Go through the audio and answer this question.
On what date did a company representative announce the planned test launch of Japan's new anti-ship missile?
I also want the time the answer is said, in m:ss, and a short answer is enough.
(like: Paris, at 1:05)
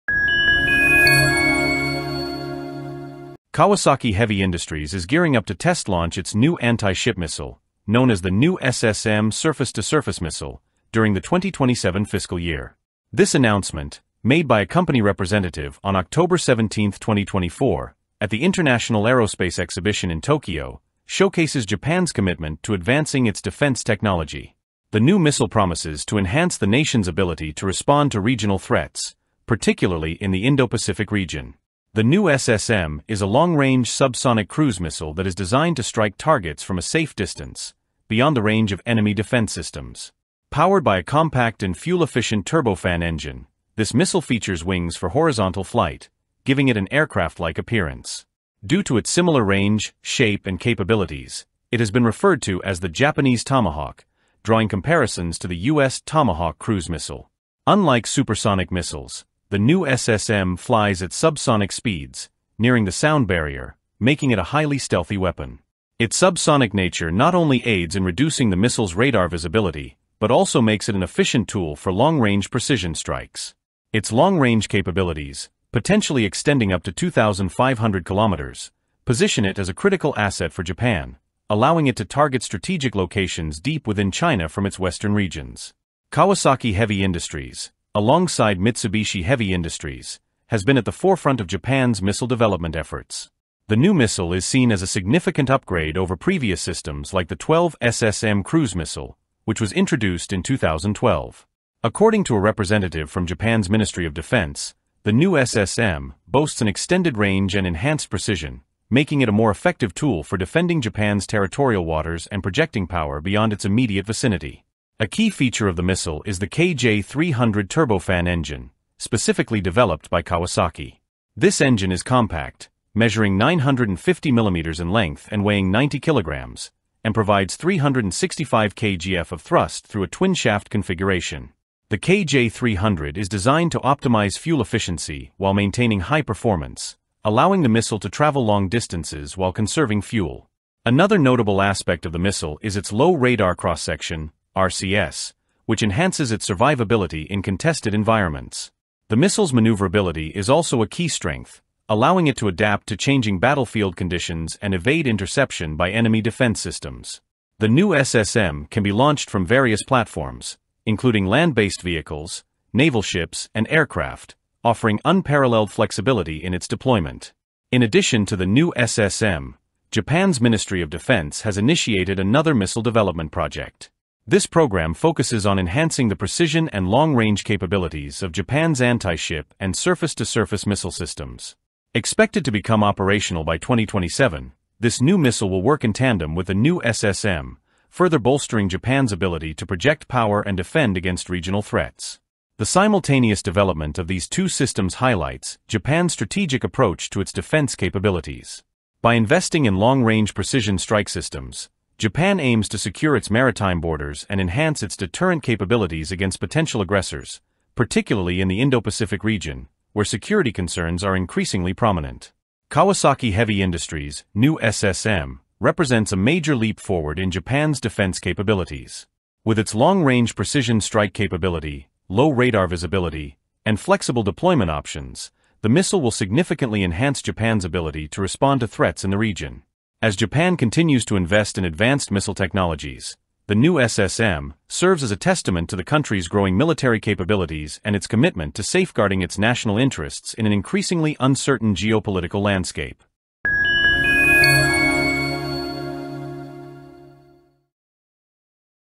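October 17, 2024, at 0:15.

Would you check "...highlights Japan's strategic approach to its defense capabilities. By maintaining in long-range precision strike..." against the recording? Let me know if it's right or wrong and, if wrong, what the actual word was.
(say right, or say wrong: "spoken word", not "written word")
wrong: "investing", not "maintaining".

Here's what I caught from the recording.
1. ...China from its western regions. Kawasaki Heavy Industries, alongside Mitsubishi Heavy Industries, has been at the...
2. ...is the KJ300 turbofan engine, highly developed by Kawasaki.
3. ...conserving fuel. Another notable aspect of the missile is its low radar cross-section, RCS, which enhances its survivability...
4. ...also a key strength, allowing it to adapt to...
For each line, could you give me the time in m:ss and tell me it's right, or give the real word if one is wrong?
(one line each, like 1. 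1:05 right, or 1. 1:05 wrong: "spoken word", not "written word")
1. 1:24 right
2. 1:56 wrong: "specifically", not "highly"
3. 2:19 right
4. 2:30 right.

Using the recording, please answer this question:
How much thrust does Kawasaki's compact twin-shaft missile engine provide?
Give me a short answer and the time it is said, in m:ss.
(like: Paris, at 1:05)
365 kgf, at 2:07.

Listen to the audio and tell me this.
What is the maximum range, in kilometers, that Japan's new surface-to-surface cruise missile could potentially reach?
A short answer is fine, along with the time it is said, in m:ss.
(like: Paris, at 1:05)
2,500 kilometers, at 1:16.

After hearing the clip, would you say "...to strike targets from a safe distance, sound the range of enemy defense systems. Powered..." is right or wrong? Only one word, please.
wrong.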